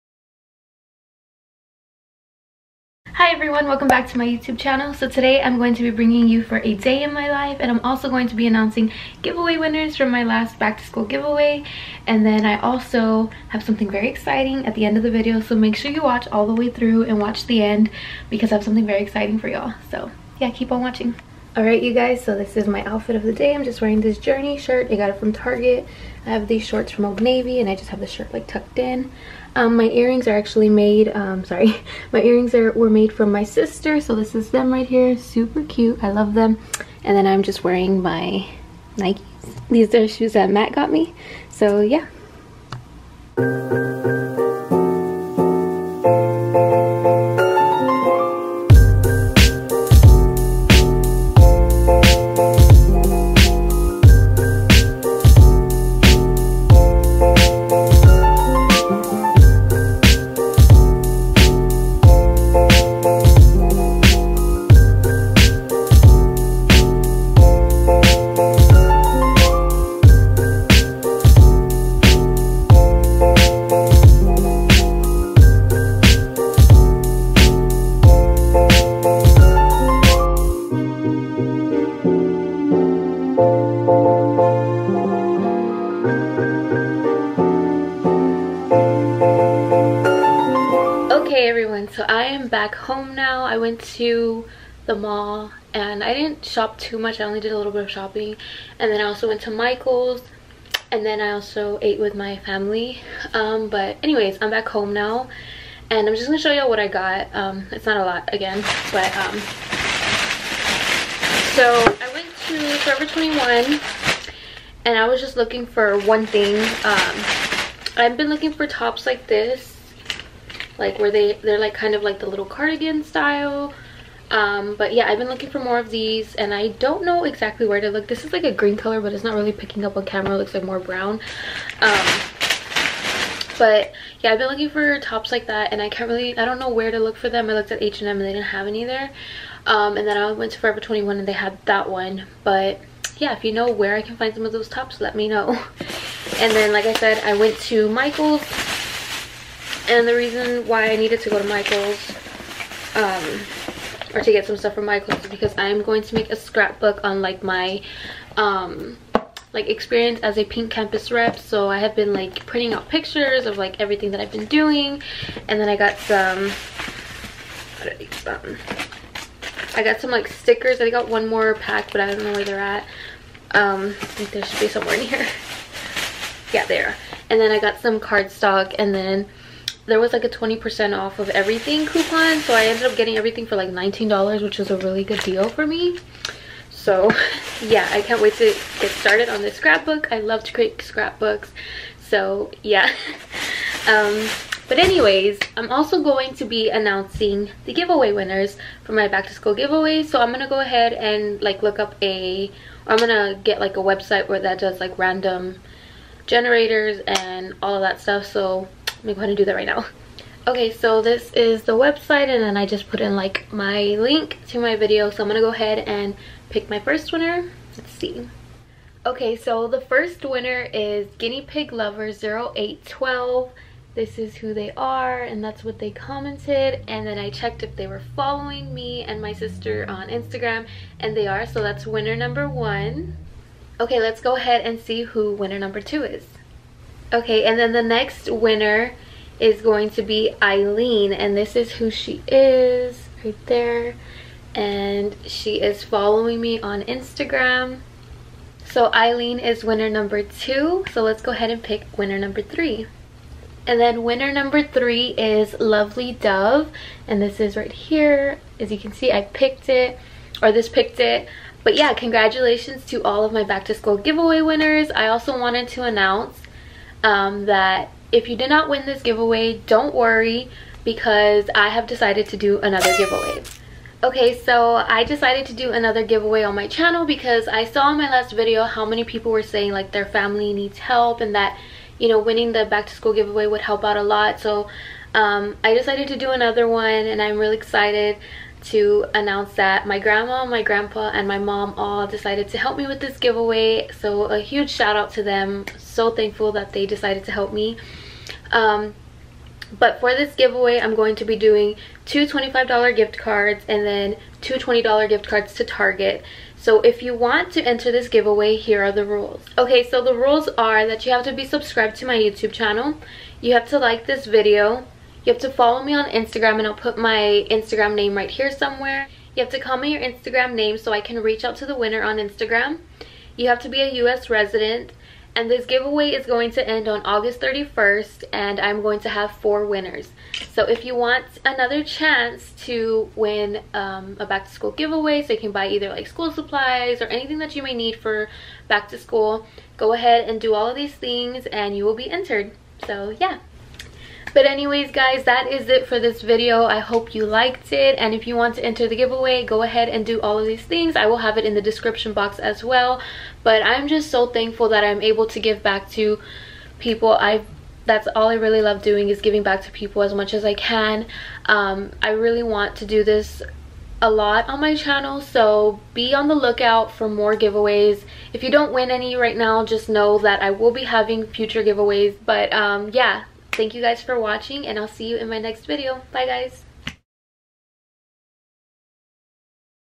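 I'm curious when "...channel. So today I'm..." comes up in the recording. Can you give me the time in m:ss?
0:04.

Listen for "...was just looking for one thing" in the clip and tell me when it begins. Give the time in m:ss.
1:55.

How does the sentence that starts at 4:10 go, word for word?
So let's go ahead and pick winner number three.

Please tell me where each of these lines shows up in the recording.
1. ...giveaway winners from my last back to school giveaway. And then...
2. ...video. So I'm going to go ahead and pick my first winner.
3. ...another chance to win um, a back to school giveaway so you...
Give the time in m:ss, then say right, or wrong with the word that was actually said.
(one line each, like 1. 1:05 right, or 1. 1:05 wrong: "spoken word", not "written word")
1. 0:09 right
2. 3:34 right
3. 5:31 right.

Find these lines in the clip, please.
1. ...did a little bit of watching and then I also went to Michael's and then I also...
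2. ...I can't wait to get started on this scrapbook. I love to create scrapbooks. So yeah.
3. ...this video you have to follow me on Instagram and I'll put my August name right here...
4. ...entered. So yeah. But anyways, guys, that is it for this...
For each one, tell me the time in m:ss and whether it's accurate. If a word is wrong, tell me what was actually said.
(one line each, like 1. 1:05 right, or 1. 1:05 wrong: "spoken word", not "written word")
1. 1:37 wrong: "shopping", not "watching"
2. 3:07 right
3. 5:14 wrong: "Instagram", not "August"
4. 5:42 right.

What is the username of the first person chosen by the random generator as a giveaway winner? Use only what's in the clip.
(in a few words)
Guinea Pig Lover 0812.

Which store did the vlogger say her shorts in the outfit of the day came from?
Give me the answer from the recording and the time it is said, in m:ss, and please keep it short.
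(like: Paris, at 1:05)
Old Navy, at 0:27.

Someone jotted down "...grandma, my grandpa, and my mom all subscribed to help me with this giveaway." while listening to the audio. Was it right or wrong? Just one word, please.
wrong.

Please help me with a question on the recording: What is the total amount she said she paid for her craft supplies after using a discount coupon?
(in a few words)
$19.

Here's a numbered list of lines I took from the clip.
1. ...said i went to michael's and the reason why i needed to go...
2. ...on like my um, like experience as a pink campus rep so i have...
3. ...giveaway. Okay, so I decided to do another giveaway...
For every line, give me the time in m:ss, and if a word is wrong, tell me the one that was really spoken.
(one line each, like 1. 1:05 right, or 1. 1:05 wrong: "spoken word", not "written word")
1. 2:26 right
2. 2:37 right
3. 4:32 right.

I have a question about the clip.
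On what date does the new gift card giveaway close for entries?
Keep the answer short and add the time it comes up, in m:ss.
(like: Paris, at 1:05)
August 31st, at 5:27.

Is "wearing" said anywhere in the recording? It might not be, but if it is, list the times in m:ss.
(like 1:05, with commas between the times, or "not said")
0:23, 0:37.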